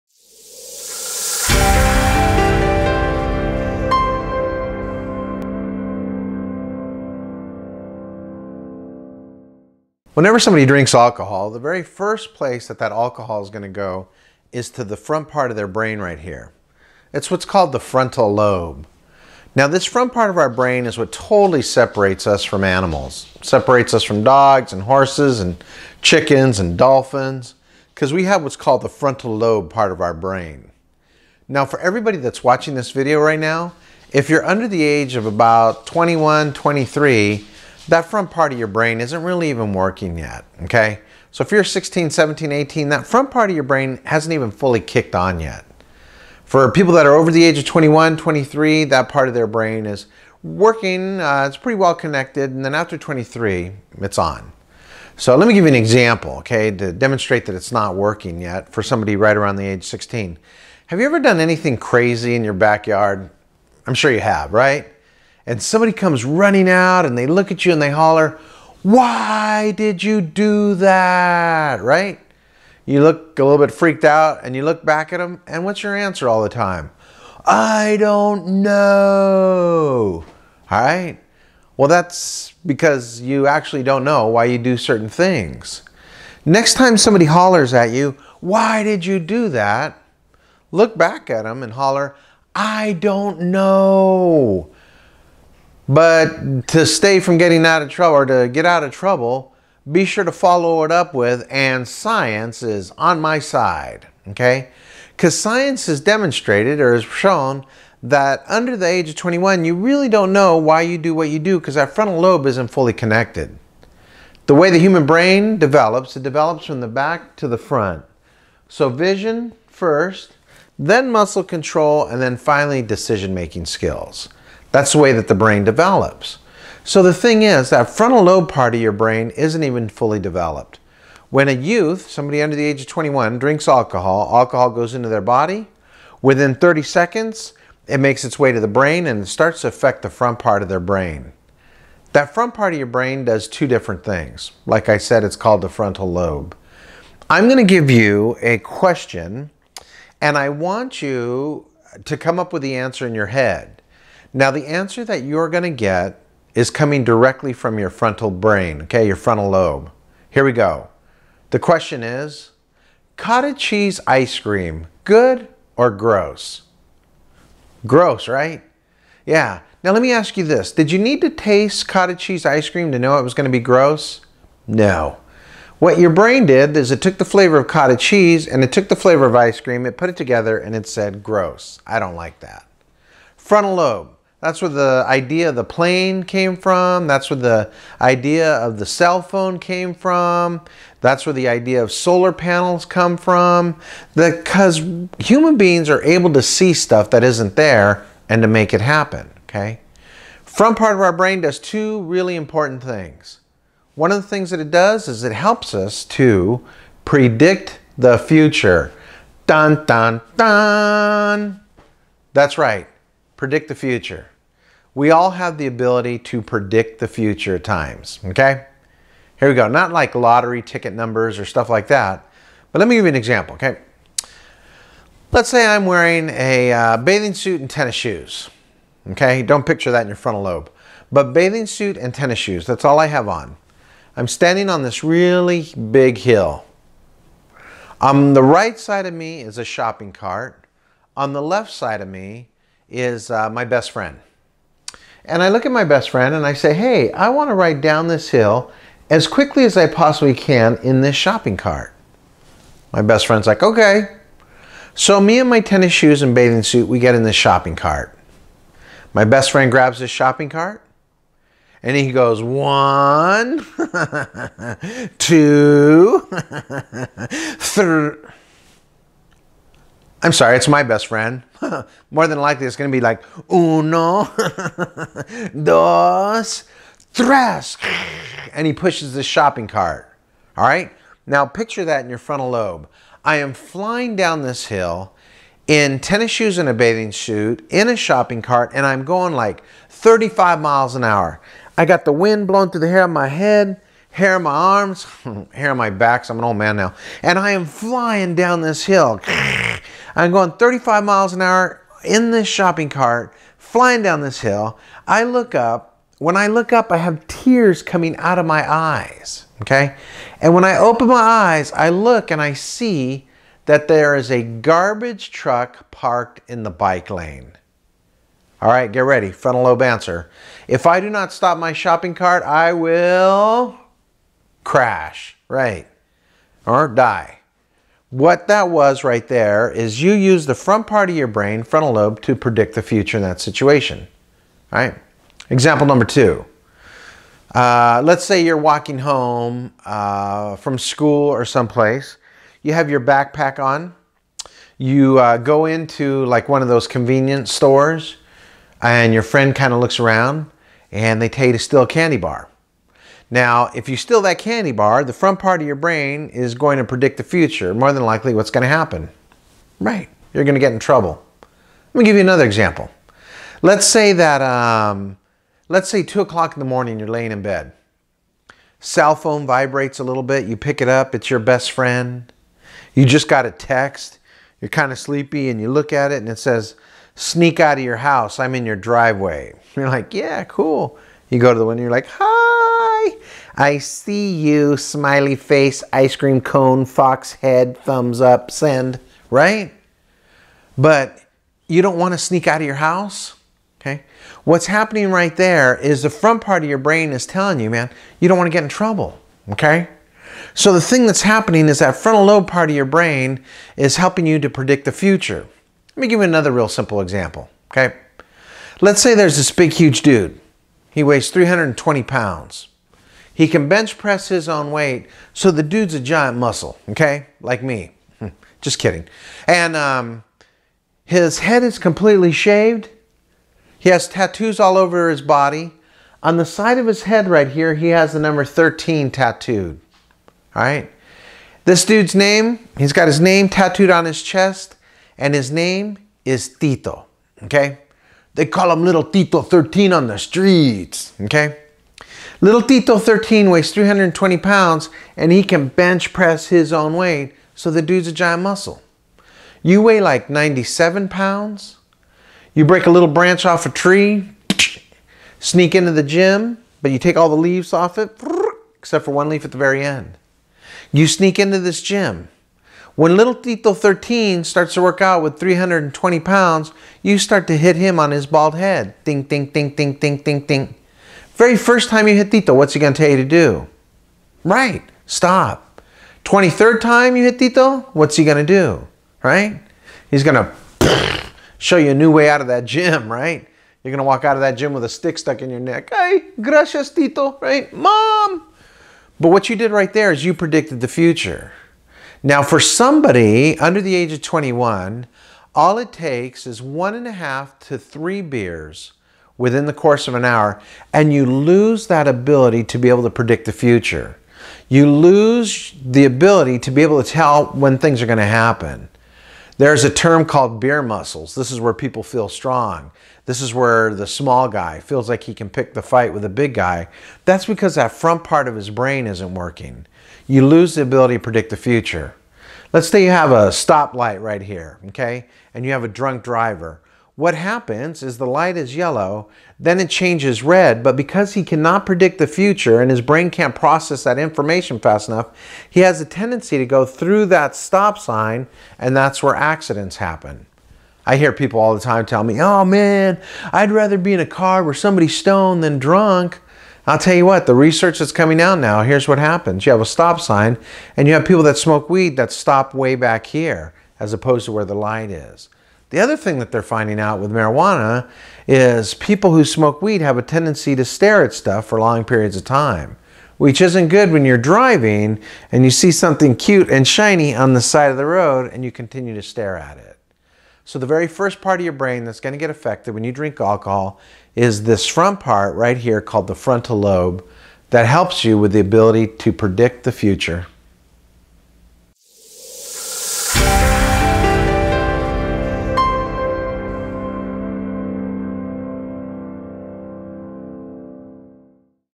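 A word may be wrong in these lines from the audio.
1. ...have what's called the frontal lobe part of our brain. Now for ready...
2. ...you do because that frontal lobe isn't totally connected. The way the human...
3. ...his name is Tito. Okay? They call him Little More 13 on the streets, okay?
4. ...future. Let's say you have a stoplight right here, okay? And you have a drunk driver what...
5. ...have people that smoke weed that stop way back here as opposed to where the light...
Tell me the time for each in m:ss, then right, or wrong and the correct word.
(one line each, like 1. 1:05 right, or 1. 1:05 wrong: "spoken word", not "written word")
1. 0:28 wrong: "everybody", not "ready"
2. 1:51 wrong: "fully", not "totally"
3. 7:15 wrong: "Tito", not "More"
4. 8:41 right
5. 9:11 right.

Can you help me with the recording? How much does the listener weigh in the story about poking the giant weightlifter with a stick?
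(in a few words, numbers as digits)
97 pounds.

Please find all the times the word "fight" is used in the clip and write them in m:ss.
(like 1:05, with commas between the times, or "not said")
8:35.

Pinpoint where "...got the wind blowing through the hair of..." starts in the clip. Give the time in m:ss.
4:51.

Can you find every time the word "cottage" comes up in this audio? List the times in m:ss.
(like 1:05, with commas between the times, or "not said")
2:43, 2:51, 2:57.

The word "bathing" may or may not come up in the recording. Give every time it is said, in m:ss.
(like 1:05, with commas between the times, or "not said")
3:46, 3:51, 4:16, 4:46.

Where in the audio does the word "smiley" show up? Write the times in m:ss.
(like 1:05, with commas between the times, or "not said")
6:24.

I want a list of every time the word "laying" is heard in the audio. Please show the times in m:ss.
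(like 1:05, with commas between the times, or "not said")
6:07.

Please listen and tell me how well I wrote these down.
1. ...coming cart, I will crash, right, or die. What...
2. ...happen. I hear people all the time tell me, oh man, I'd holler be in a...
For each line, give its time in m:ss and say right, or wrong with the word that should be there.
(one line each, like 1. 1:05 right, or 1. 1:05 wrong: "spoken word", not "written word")
1. 5:21 wrong: "shopping", not "coming"
2. 8:59 wrong: "rather", not "holler".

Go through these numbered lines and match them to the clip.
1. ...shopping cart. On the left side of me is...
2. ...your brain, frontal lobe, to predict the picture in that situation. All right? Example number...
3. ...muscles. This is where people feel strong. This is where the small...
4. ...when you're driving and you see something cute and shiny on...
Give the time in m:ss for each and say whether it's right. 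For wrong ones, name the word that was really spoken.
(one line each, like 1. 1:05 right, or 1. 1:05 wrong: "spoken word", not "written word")
1. 3:59 right
2. 5:31 wrong: "future", not "picture"
3. 8:30 right
4. 9:24 right.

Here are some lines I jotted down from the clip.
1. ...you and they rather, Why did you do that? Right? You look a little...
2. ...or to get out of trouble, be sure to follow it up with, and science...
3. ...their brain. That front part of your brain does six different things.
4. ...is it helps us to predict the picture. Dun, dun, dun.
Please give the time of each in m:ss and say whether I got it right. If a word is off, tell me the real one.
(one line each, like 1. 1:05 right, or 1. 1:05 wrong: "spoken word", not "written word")
1. 1:07 wrong: "holler", not "rather"
2. 1:38 right
3. 2:20 wrong: "two", not "six"
4. 3:25 wrong: "future", not "picture".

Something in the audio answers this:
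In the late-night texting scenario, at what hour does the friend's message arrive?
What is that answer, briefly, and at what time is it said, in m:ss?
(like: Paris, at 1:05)
2 o'clock, at 6:06.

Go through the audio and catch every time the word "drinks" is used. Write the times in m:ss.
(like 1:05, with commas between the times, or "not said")
0:10, 2:13, 9:33.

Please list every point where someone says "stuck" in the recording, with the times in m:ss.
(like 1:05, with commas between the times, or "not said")
8:05.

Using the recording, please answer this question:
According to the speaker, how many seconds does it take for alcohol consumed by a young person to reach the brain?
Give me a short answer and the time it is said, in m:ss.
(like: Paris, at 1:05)
30, at 2:16.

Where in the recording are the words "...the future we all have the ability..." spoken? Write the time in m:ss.
3:33.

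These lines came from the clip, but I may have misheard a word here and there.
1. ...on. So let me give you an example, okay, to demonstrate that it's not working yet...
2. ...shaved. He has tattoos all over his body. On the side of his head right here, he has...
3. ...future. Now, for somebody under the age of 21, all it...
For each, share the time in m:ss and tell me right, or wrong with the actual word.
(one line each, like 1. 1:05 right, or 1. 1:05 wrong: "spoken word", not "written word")
1. 0:54 right
2. 7:02 right
3. 8:10 right.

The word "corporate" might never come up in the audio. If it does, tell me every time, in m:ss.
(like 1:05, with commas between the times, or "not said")
not said.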